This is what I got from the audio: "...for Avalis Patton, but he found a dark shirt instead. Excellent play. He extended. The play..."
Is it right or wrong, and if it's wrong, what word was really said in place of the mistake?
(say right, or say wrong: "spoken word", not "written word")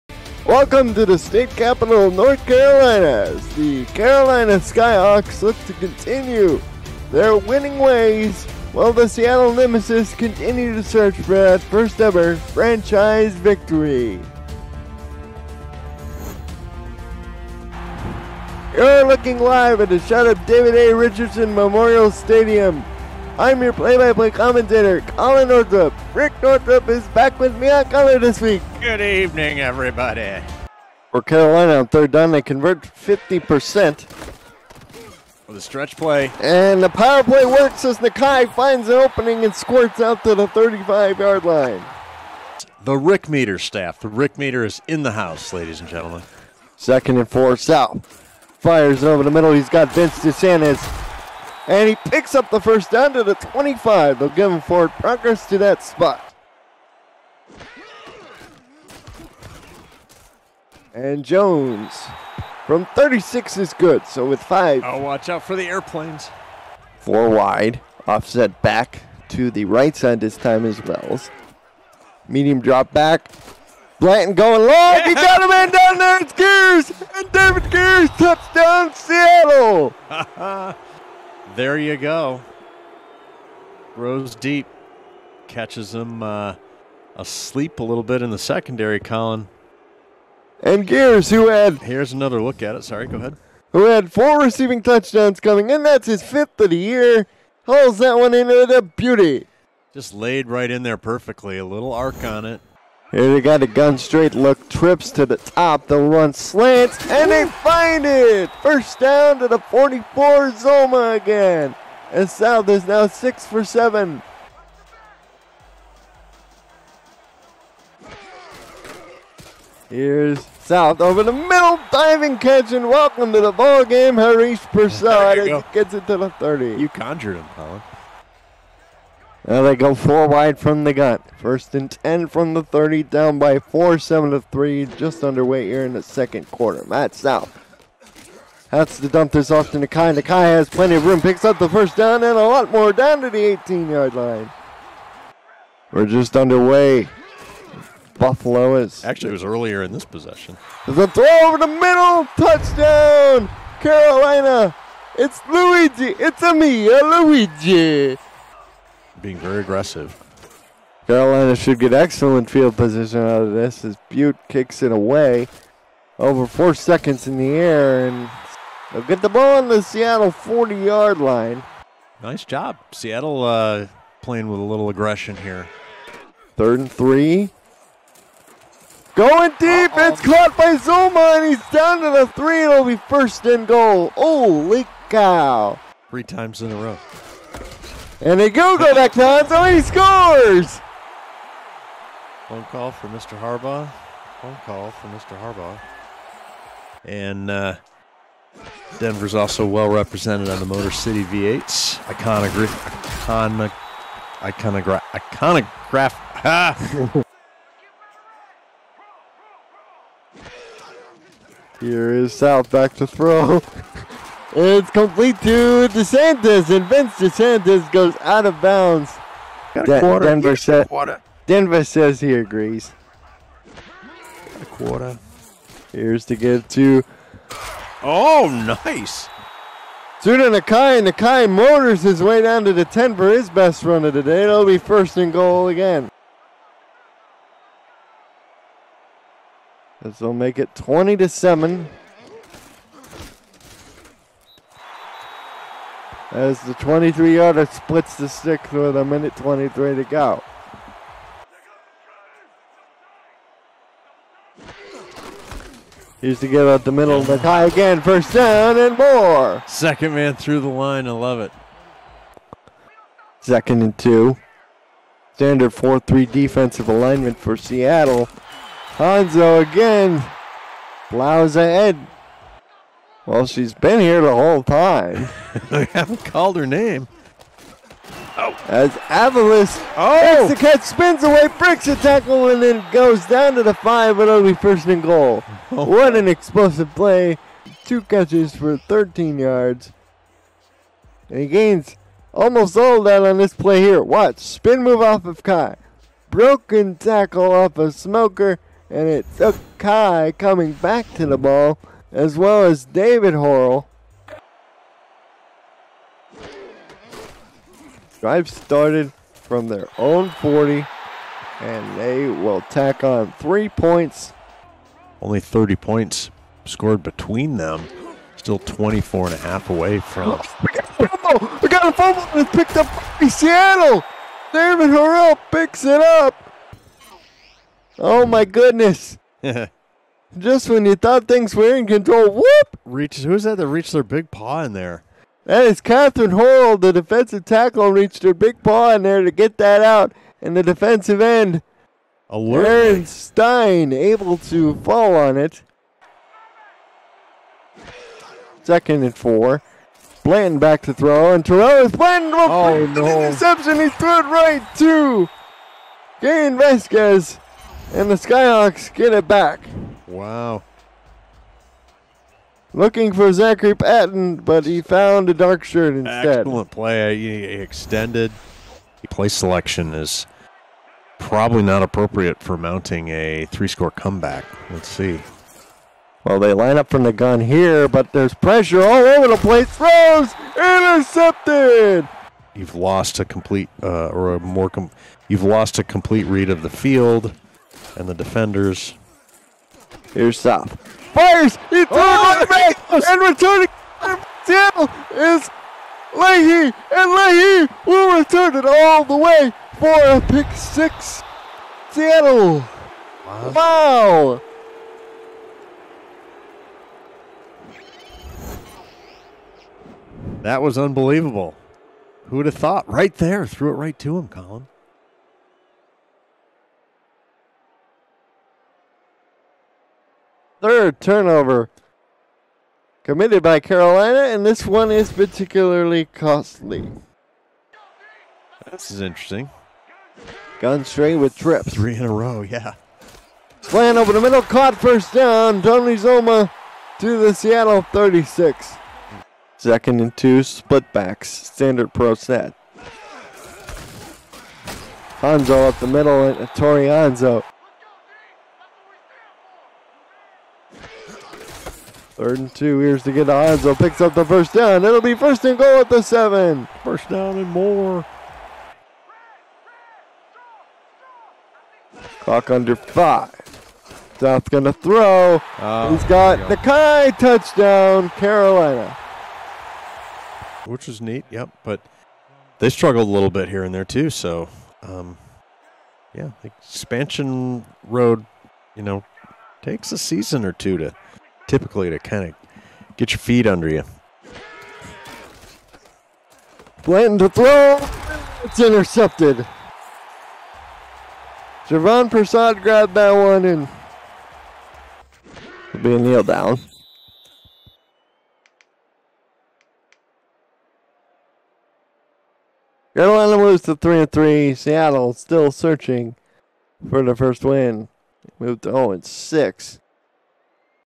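wrong: "Zachary", not "Avalis".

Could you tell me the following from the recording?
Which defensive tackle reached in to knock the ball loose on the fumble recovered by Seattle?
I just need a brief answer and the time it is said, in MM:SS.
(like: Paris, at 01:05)
Catherine Hoyle, at 05:35.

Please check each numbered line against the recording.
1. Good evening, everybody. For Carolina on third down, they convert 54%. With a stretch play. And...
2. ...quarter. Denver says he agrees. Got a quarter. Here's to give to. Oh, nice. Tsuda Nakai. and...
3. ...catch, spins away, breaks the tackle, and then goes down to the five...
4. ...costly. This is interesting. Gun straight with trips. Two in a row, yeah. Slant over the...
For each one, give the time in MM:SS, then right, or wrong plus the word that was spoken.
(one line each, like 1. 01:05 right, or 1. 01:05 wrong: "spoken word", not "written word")
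1. 00:28 wrong: "50", not "54"
2. 03:40 right
3. 04:40 right
4. 07:06 wrong: "Three", not "Two".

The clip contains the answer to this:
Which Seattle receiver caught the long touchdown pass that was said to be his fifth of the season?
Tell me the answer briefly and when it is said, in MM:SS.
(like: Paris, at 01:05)
David Gears, at 01:17.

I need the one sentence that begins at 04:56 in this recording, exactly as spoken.
Broken tackle off of Smoker, and it's Kai coming back to the ball as well as David Horrell.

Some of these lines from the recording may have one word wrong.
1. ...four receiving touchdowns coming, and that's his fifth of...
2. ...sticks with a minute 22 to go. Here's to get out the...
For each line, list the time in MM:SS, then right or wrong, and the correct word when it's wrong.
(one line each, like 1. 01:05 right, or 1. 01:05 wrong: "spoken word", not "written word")
1. 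01:34 right
2. 04:08 wrong: "23", not "22".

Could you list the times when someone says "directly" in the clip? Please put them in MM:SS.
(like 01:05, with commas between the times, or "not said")
not said.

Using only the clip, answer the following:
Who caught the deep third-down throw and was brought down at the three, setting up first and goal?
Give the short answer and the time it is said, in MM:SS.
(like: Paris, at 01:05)
Zuma, at 03:00.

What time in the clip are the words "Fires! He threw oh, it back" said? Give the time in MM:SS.
06:31.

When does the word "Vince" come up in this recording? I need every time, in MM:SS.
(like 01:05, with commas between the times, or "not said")
00:49, 03:36.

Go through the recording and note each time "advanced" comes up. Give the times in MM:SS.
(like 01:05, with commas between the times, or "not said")
not said.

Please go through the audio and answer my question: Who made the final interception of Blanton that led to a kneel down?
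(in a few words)
Javon Prasad.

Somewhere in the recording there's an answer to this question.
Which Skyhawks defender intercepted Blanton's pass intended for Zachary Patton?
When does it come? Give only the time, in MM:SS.
05:56.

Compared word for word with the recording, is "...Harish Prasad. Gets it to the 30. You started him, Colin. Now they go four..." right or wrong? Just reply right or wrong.
wrong.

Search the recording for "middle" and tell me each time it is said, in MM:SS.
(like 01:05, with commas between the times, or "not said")
00:49, 02:01, 02:31, 04:16, 07:14, 07:25.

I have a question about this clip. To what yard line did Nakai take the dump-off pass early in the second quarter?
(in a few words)
18.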